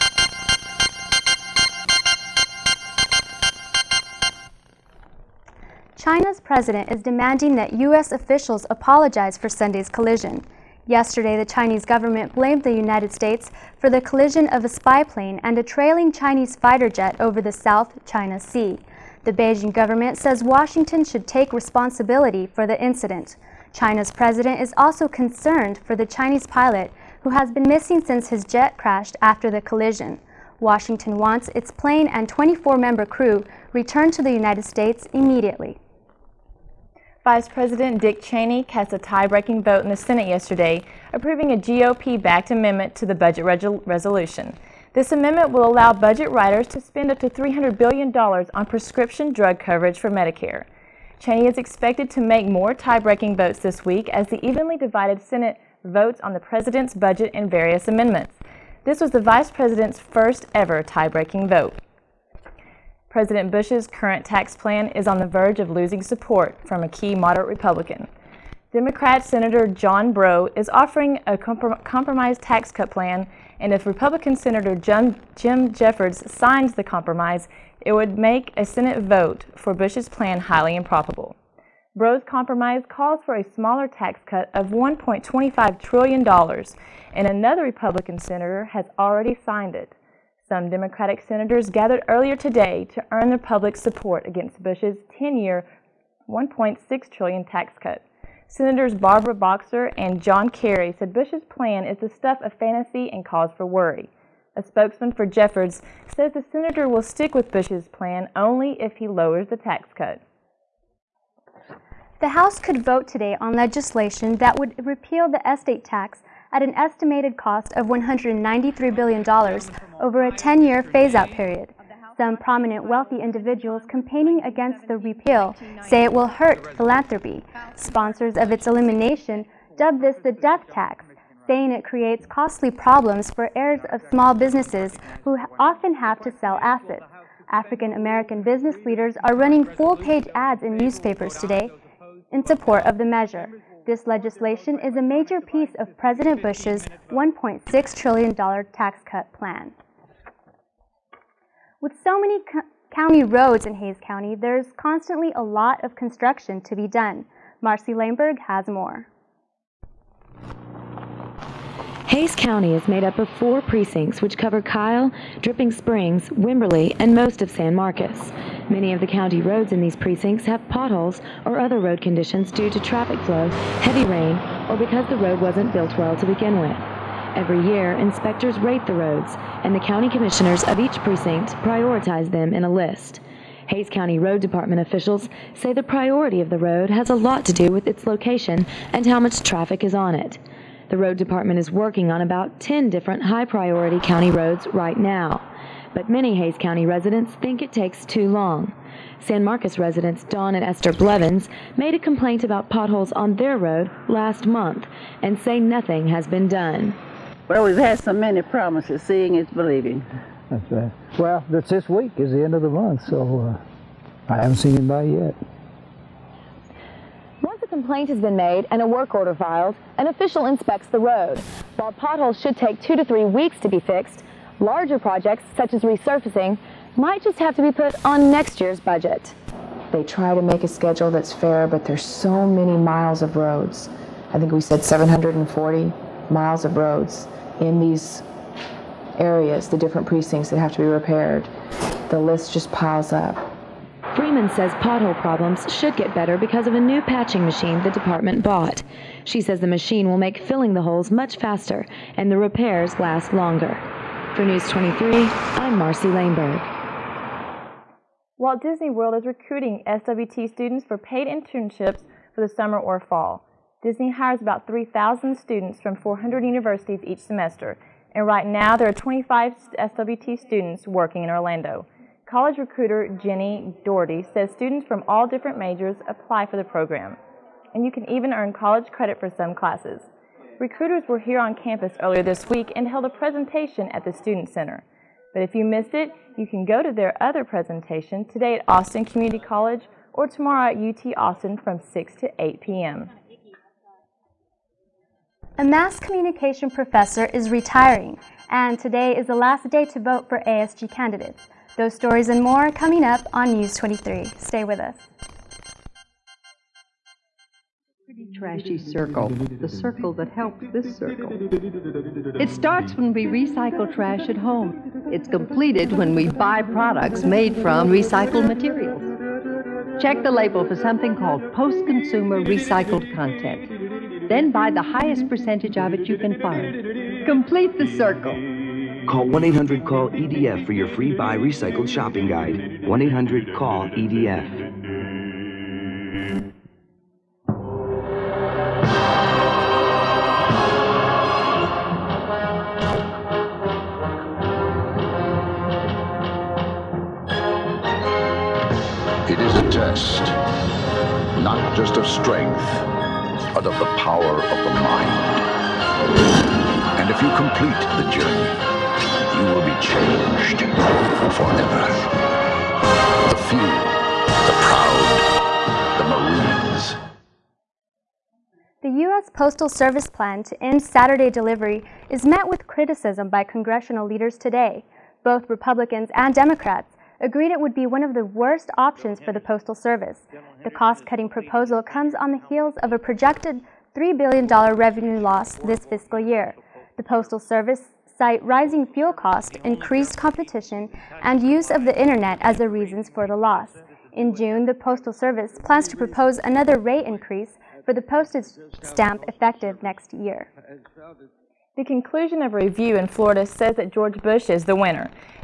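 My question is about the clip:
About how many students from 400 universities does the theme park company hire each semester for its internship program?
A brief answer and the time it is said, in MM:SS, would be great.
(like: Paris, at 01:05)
3,000, at 04:24.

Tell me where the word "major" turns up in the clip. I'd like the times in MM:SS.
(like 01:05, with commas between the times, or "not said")
02:25, 04:35.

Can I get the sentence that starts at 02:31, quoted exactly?
With so many co county roads in Hays County, there's constantly a lot of construction to be done.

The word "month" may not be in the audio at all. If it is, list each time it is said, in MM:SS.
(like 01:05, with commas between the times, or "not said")
03:24, 03:32.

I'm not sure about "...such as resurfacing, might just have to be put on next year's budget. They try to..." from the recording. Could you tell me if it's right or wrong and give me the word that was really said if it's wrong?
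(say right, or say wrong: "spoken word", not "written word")
right.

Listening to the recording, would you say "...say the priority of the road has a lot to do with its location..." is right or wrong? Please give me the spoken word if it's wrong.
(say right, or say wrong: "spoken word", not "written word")
right.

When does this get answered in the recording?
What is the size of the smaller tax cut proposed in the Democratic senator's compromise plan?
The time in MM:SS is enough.
01:24.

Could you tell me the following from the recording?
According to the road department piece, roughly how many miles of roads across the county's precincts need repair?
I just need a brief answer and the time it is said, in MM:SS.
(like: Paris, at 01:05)
740, at 03:54.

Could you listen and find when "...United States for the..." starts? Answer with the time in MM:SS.
00:12.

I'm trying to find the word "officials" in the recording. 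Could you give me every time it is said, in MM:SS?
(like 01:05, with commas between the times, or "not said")
00:08, 03:04, 03:40.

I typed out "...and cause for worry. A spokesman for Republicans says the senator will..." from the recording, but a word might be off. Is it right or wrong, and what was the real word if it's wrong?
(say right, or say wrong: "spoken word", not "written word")
wrong: "Jeffords", not "Republicans".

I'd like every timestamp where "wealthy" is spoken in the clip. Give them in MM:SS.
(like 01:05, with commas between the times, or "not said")
02:02.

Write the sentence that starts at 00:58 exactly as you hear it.
This was the vice president's first ever tie-breaking vote.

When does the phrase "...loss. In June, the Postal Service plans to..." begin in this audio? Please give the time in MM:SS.
06:33.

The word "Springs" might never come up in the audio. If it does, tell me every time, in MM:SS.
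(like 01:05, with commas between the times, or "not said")
02:45.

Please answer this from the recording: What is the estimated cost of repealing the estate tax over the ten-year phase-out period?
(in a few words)
$193 billion.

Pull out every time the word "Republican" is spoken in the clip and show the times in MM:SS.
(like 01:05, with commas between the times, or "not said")
01:07, 01:13, 01:27, 06:15.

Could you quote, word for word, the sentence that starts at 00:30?
Washington wants its plane and 24 member crew returned to the United States immediately.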